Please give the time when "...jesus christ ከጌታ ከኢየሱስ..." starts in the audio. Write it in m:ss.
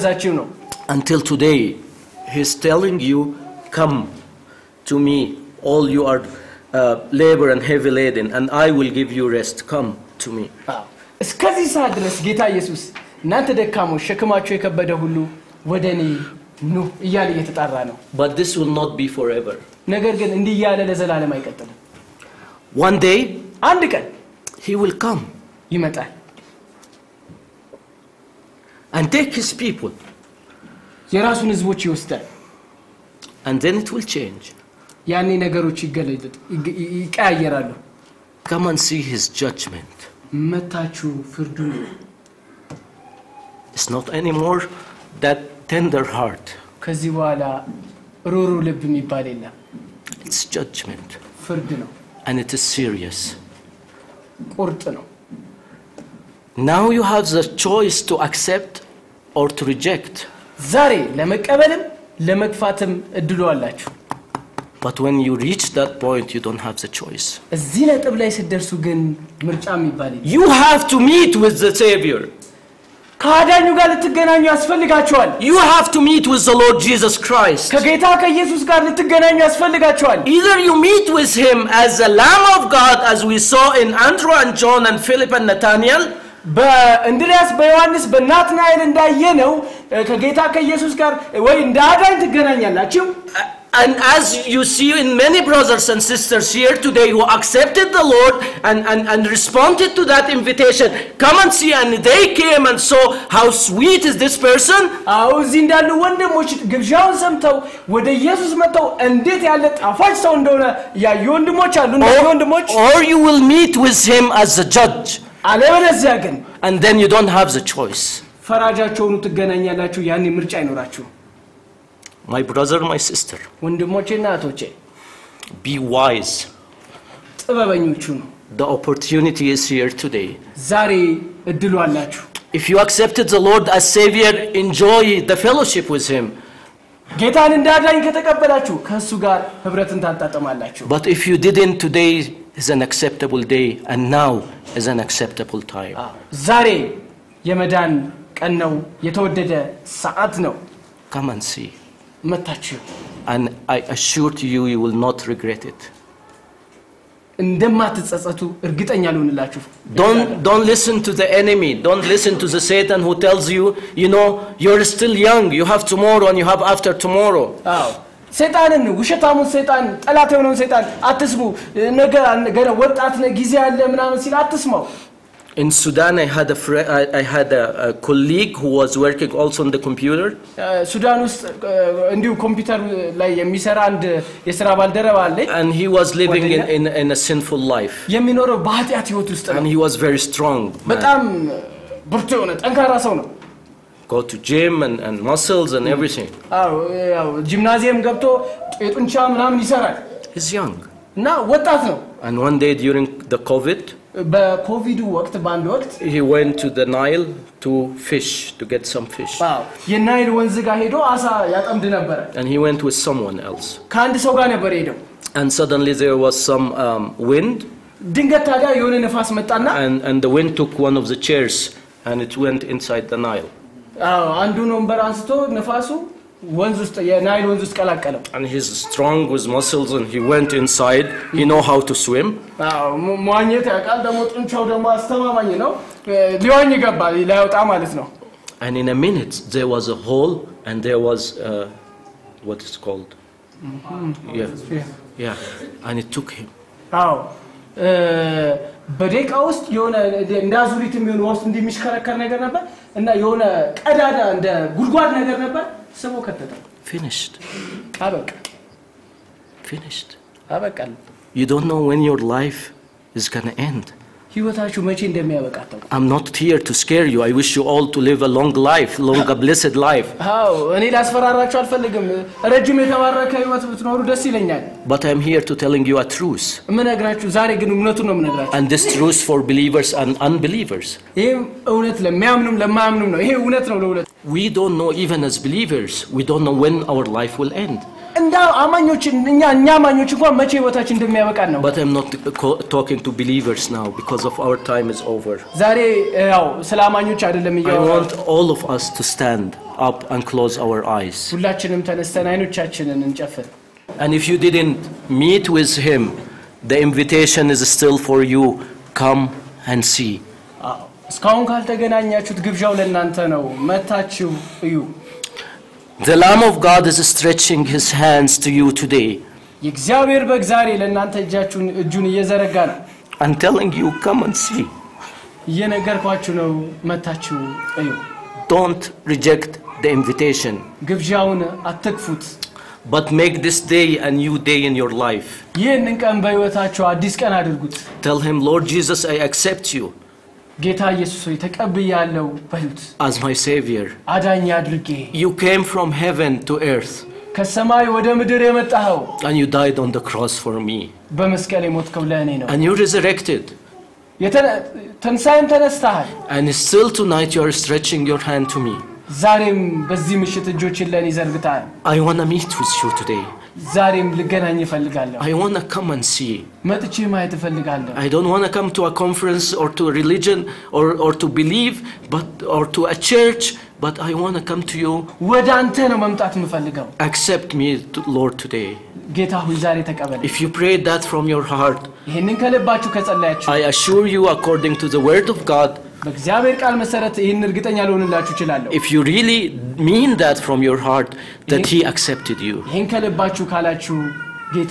1:16.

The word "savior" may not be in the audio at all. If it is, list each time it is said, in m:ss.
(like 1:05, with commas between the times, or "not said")
1:11, 2:13, 5:43.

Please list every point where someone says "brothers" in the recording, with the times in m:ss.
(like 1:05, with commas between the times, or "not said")
1:35, 2:02.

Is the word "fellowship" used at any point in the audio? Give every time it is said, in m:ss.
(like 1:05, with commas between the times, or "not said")
2:15.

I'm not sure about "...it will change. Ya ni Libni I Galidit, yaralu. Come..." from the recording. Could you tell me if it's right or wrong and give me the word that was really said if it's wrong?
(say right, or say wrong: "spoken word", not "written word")
wrong: "Yani", not "Libni".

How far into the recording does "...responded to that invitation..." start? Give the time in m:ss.
1:39.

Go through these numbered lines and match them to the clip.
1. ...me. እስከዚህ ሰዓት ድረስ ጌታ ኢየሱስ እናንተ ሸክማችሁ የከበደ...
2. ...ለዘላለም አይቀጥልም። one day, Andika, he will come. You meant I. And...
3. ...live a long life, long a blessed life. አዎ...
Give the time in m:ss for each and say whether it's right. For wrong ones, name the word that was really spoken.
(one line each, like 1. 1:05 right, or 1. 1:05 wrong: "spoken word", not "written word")
1. 0:10 right
2. 0:20 right
3. 4:28 right.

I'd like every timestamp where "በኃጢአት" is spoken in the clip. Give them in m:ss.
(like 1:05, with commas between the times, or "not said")
3:08.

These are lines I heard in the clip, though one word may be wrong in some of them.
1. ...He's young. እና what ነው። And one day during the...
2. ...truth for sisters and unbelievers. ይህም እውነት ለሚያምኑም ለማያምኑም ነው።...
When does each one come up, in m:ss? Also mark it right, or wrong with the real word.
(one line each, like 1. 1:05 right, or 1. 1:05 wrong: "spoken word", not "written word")
1. 3:20 right
2. 4:38 wrong: "believers", not "sisters".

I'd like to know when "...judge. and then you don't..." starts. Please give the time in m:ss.
1:54.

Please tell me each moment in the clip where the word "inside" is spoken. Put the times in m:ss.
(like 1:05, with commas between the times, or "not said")
3:42, 3:50.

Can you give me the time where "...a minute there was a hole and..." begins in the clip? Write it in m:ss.
3:58.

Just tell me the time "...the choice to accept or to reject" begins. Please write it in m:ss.
0:57.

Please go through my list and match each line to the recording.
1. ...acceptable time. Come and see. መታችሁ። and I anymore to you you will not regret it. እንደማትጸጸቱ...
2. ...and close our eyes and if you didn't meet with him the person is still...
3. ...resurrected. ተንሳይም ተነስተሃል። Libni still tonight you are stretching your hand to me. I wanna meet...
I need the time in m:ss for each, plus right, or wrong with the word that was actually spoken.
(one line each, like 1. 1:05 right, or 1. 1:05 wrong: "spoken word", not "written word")
1. 2:24 wrong: "assure", not "anymore"
2. 5:00 wrong: "invitation", not "person"
3. 5:52 wrong: "And", not "Libni".